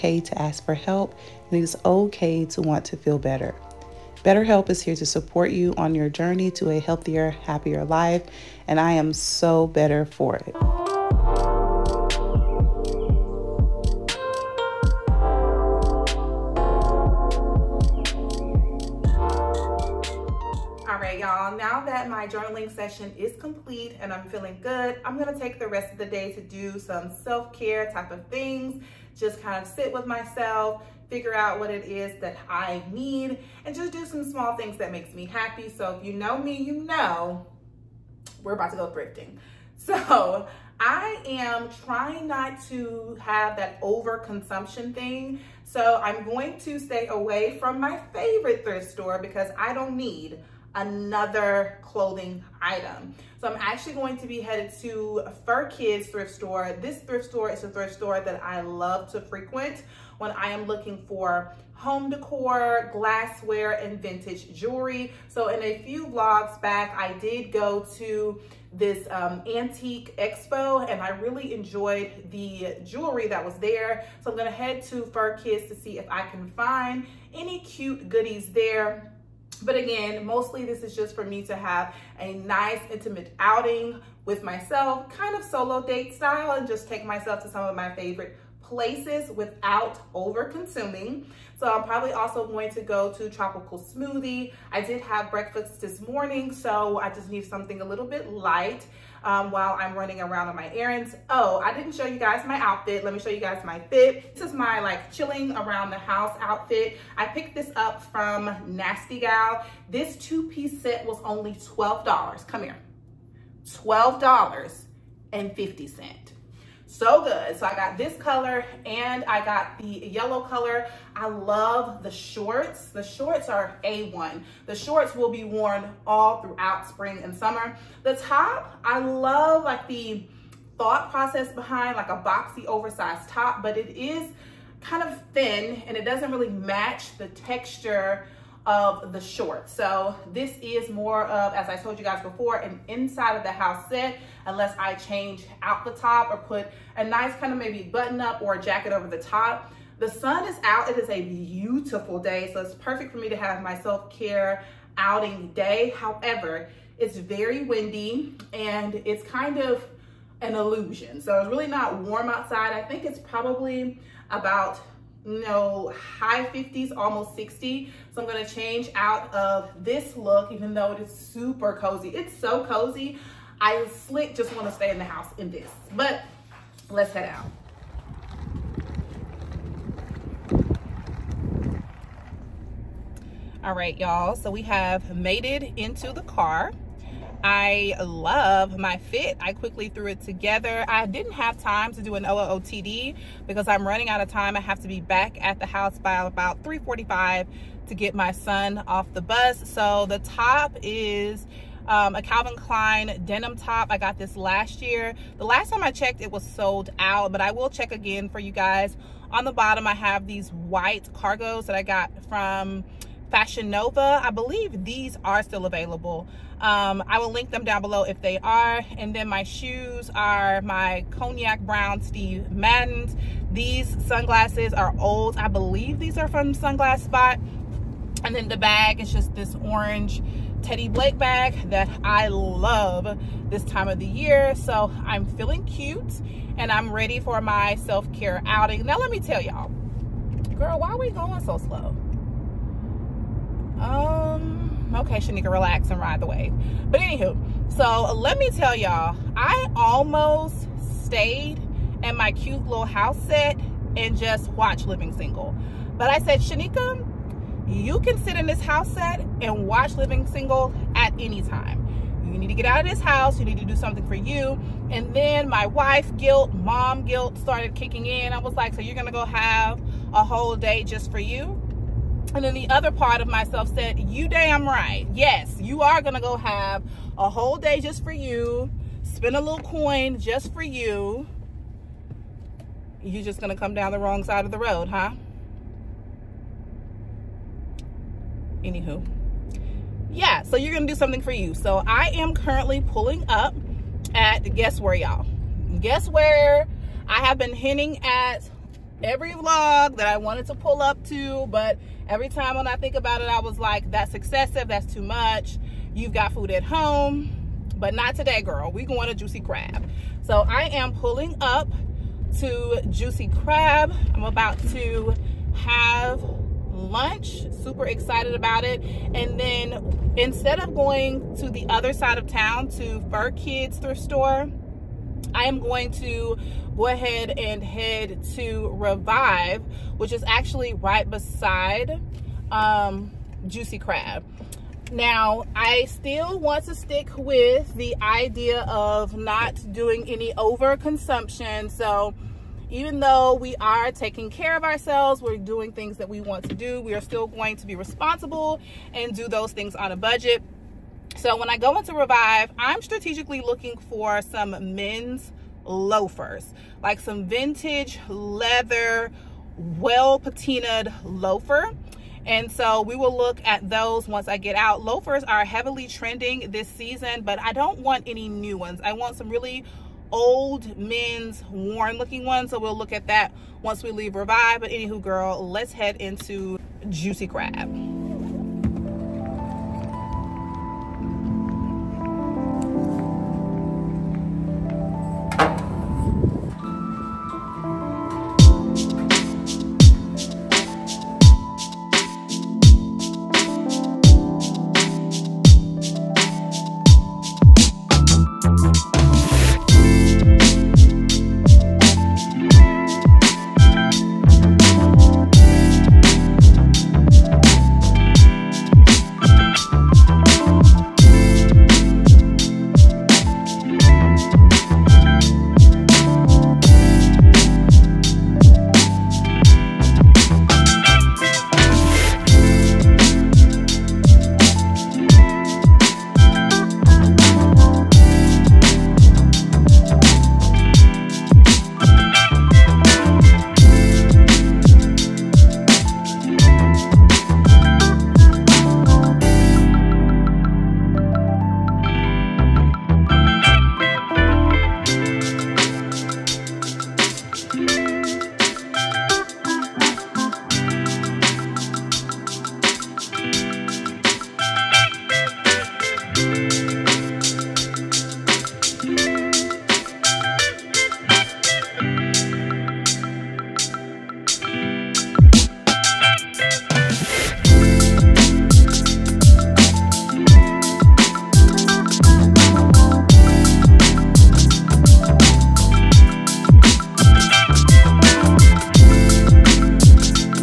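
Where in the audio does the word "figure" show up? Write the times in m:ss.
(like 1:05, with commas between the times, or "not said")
0:31.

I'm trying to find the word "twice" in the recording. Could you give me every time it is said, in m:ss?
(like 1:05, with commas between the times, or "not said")
not said.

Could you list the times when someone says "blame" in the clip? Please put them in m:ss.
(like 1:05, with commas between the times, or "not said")
not said.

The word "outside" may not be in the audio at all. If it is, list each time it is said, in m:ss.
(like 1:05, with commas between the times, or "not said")
2:42.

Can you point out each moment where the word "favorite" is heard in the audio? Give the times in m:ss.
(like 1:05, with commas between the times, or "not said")
0:48, 1:27.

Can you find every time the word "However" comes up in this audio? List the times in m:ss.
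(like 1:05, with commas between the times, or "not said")
2:35.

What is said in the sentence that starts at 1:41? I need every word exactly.
Oh, I didn't show you guys my outfit.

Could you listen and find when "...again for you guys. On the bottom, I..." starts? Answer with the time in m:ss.
3:27.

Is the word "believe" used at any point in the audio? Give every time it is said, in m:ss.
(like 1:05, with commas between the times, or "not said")
3:34, 3:45.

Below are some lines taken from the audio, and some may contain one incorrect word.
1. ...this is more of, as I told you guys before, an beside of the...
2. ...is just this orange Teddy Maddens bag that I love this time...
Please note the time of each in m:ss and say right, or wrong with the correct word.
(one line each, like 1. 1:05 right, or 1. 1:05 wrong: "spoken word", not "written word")
1. 2:20 wrong: "inside", not "beside"
2. 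3:49 wrong: "Blake", not "Maddens".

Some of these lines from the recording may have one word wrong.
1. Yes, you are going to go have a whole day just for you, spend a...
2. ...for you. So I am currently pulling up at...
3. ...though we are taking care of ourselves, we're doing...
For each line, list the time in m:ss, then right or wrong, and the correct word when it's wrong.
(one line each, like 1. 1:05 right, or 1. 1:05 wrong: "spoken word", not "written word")
1. 4:35 right
2. 4:51 right
3. 5:42 right.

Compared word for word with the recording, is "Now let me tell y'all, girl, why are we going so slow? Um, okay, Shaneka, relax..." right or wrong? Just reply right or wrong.
right.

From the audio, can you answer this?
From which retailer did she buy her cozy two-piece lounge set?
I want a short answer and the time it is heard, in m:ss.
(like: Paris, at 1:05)
Nasty Gal, at 1:48.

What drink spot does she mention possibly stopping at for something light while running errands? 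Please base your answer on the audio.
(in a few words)
Tropical Smoothie.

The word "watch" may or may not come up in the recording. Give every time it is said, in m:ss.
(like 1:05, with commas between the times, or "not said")
4:14, 4:19.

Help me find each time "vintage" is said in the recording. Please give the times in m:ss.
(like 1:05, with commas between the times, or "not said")
1:04, 5:57.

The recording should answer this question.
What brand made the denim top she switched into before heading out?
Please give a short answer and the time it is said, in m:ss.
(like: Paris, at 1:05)
Calvin Klein, at 3:22.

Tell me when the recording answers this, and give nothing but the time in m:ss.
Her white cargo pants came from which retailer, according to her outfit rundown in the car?
3:33.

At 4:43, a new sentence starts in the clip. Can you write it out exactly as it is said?
You're just going to come down the wrong side of the road, huh?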